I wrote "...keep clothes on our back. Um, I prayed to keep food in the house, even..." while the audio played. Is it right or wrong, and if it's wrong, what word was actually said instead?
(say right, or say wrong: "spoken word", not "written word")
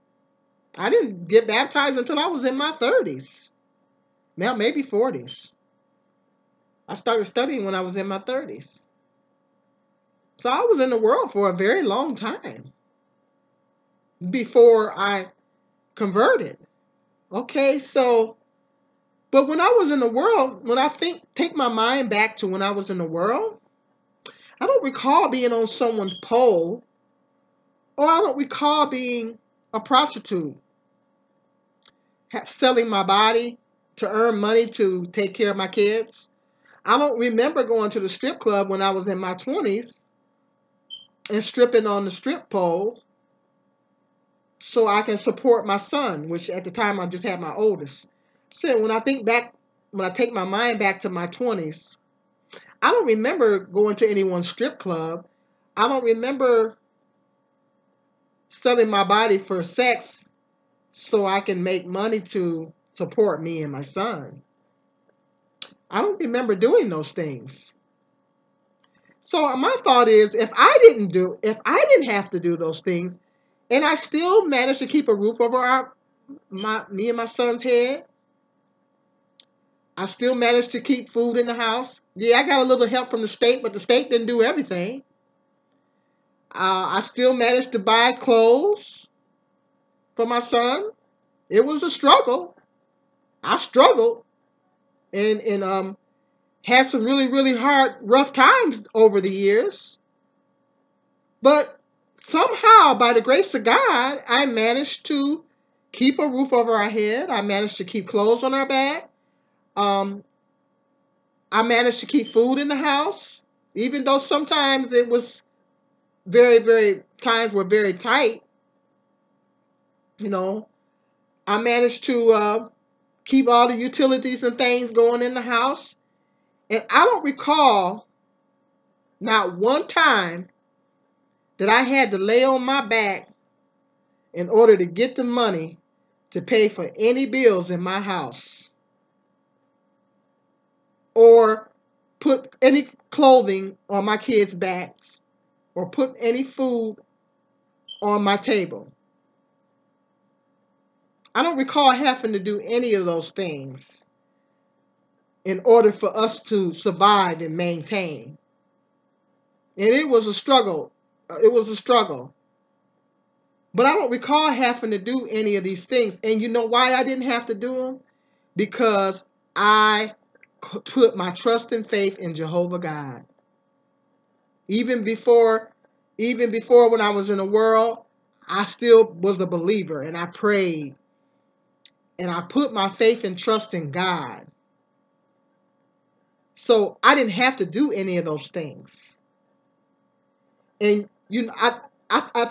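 wrong: "managed", not "prayed".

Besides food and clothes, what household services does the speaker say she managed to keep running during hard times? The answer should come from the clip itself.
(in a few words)
utilities.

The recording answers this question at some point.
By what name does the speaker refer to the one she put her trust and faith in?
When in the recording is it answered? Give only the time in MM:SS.
02:52.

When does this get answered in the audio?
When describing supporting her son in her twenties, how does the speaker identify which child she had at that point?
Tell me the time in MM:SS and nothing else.
00:47.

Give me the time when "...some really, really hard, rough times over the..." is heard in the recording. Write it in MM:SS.
01:36.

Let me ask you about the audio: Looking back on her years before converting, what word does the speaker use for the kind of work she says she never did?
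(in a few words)
prostitute.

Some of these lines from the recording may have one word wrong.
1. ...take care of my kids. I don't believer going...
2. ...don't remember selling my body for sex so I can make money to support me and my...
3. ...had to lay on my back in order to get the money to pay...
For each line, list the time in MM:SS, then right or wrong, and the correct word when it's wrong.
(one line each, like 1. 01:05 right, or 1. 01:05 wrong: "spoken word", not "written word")
1. 00:35 wrong: "remember", not "believer"
2. 00:55 right
3. 02:11 right.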